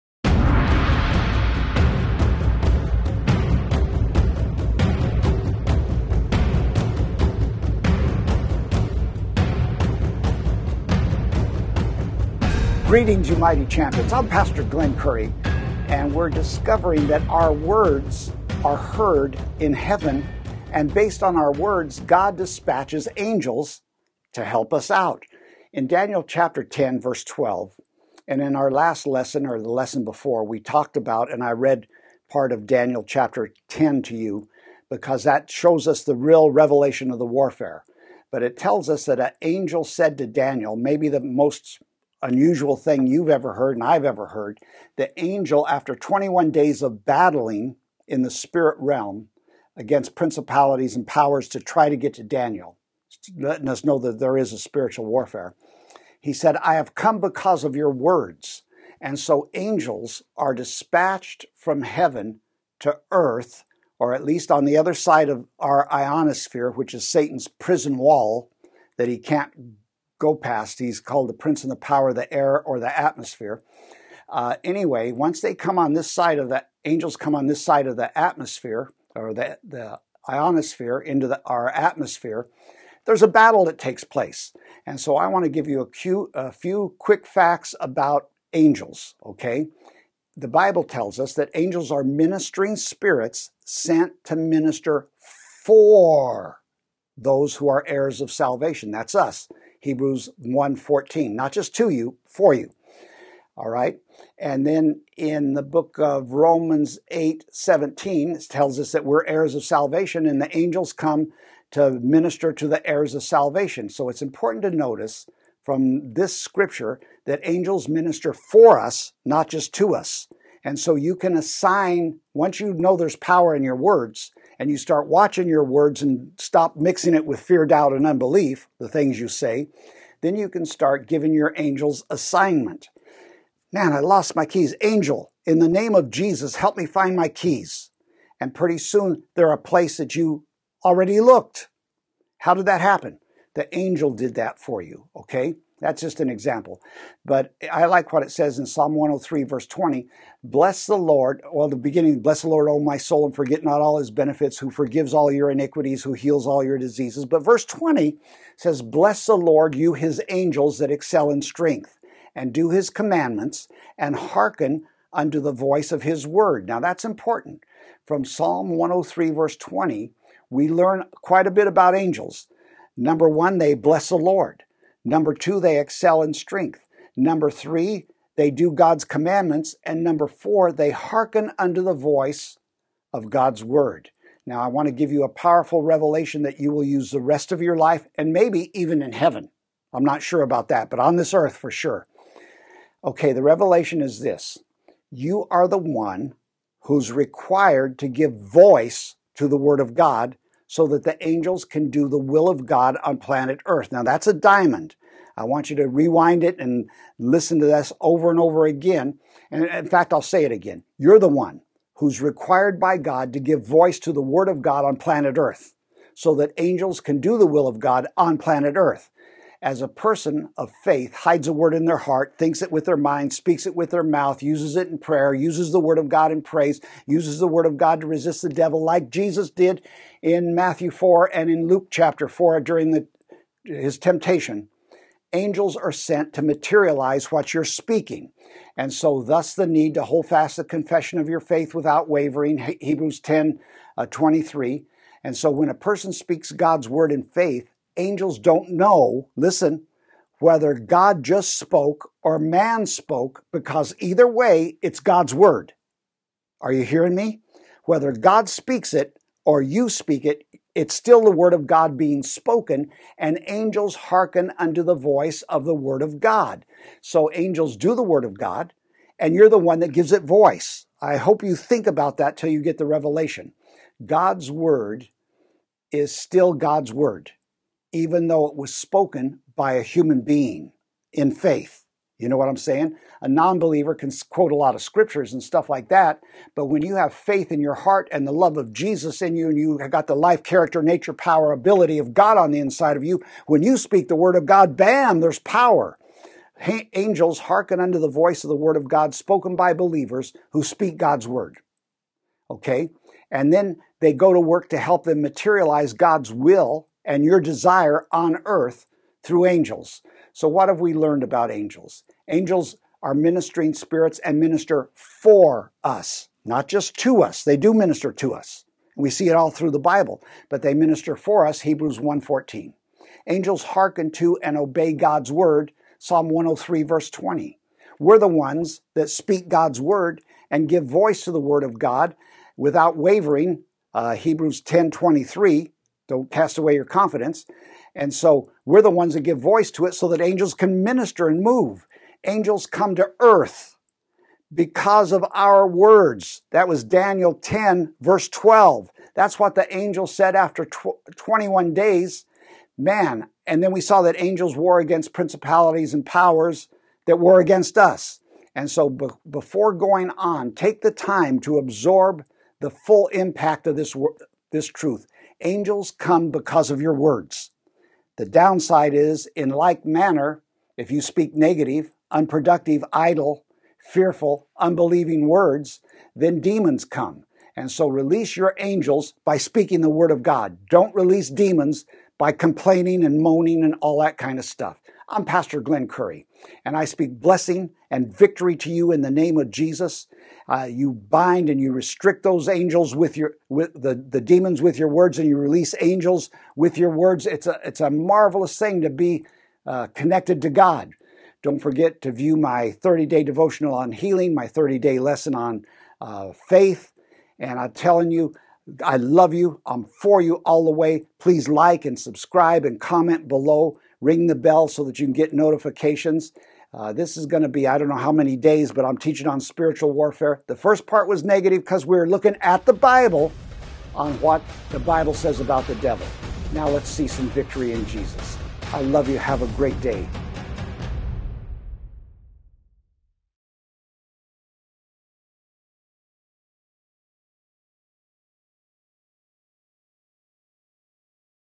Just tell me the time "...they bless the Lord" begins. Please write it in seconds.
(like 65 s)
173 s.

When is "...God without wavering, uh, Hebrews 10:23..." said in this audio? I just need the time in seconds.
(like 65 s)
331 s.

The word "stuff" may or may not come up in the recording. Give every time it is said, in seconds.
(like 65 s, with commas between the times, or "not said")
285 s, 384 s.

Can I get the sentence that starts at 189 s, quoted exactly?
I'm not sure about that, but on this earth for sure.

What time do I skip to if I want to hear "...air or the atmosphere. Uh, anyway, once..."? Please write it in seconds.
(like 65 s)
72 s.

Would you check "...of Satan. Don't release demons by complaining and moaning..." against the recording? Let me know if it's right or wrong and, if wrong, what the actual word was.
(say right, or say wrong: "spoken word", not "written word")
wrong: "God", not "Satan".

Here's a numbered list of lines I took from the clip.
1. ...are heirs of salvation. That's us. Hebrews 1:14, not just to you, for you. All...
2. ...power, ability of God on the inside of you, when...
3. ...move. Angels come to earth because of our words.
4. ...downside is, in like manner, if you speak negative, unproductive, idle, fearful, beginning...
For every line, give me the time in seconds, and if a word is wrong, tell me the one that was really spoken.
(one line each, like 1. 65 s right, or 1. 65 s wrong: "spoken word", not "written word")
1. 97 s right
2. 291 s right
3. 341 s right
4. 368 s wrong: "unbelieving", not "beginning".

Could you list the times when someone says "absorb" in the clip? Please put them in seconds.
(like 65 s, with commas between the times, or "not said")
361 s.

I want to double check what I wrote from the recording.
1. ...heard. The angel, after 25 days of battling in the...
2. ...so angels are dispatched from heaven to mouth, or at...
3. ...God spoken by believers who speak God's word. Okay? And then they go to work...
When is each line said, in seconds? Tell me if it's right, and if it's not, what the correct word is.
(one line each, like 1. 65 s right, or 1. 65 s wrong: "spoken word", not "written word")
1. 44 s wrong: "21", not "25"
2. 59 s wrong: "earth", not "mouth"
3. 298 s right.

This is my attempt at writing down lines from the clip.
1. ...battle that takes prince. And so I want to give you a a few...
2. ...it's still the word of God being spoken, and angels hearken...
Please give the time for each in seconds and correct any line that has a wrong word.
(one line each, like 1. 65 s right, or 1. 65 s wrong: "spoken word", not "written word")
1. 83 s wrong: "place", not "prince"
2. 260 s right.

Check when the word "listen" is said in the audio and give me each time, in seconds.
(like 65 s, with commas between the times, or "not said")
207 s, 249 s.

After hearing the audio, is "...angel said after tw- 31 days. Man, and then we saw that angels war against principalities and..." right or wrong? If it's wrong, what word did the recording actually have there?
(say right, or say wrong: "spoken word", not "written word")
wrong: "21", not "31".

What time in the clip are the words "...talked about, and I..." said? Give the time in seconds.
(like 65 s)
30 s.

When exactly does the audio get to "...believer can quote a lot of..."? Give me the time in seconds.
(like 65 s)
283 s.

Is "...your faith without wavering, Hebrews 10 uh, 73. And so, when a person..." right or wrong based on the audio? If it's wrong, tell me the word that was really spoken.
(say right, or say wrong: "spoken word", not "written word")
wrong: "23", not "73".